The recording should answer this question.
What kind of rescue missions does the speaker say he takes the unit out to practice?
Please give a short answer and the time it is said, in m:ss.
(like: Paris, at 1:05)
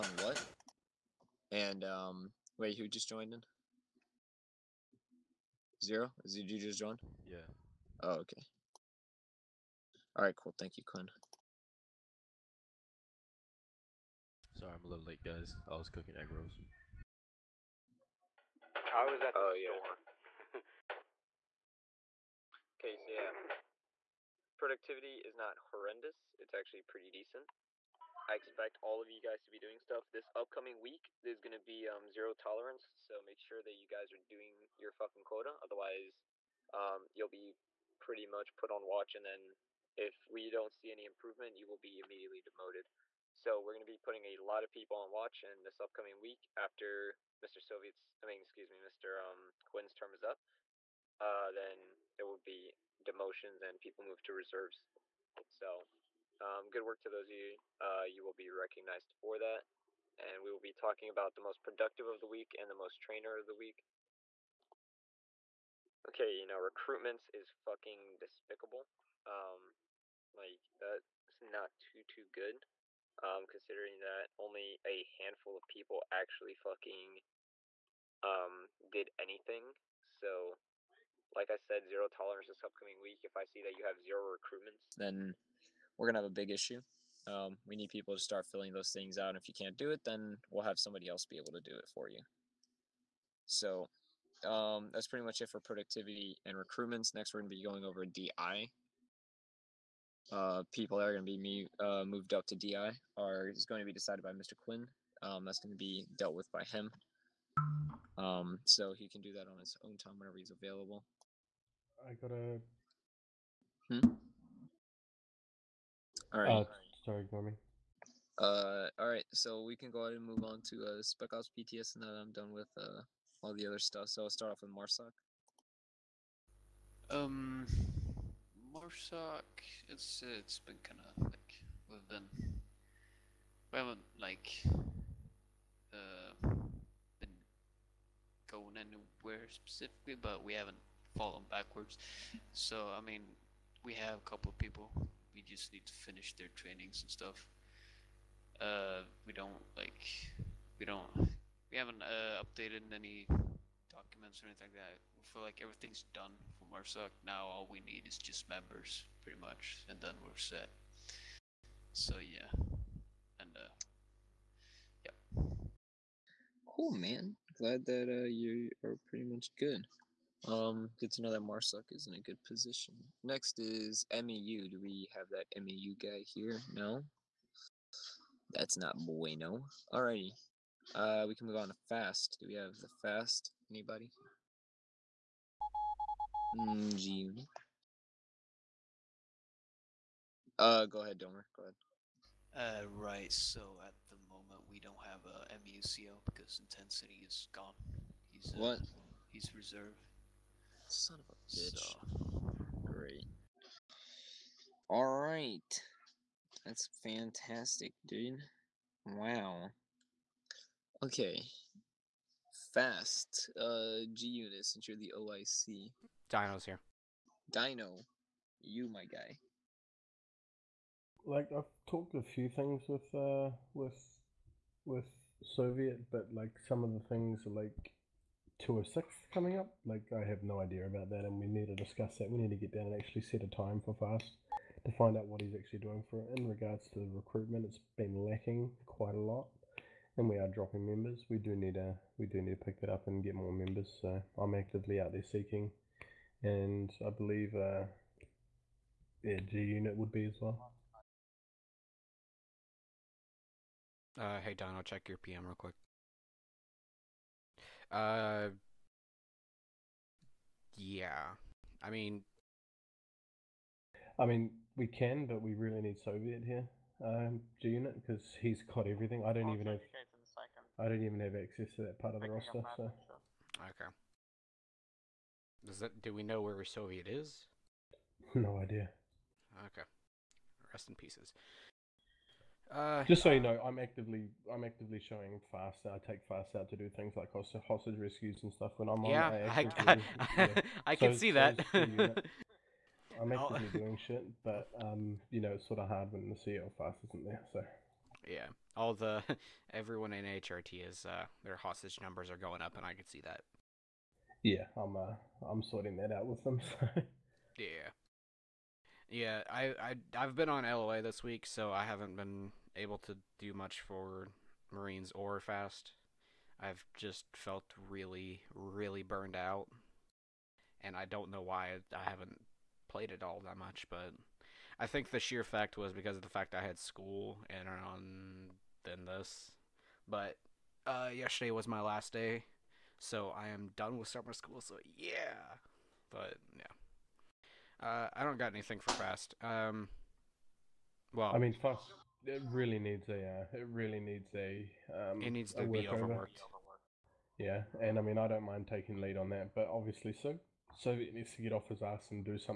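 hostage rescues, at 4:47.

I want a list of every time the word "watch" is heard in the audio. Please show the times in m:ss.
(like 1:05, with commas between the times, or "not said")
0:38, 0:45.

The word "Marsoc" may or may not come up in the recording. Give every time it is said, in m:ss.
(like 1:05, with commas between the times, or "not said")
2:04, 2:08, 2:36, 2:51.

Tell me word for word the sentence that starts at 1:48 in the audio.
Um, so he can do that on his own time whenever he's available.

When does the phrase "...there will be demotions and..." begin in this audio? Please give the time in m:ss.
0:52.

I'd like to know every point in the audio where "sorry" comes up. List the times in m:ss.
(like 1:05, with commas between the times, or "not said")
0:14, 1:57.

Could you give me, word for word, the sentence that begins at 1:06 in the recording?
Okay, you know, recruitments is fucking despicable.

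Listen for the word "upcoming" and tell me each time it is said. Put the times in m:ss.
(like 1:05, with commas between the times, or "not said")
0:30, 0:45, 1:22.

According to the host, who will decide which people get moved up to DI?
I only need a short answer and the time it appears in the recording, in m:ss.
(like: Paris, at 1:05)
Mr. Quinn, at 1:44.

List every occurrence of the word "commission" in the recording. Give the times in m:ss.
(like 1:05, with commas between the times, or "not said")
not said.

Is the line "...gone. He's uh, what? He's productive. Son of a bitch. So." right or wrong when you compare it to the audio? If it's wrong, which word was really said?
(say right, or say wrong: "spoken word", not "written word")
wrong: "reserve", not "productive".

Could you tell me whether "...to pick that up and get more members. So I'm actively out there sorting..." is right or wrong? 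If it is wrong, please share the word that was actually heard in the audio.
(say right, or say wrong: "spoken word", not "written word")
wrong: "seeking", not "sorting".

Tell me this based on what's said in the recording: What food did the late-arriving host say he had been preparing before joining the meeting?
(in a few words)
egg rolls.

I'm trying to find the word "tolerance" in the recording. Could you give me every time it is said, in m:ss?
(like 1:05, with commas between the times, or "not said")
0:32, 1:22.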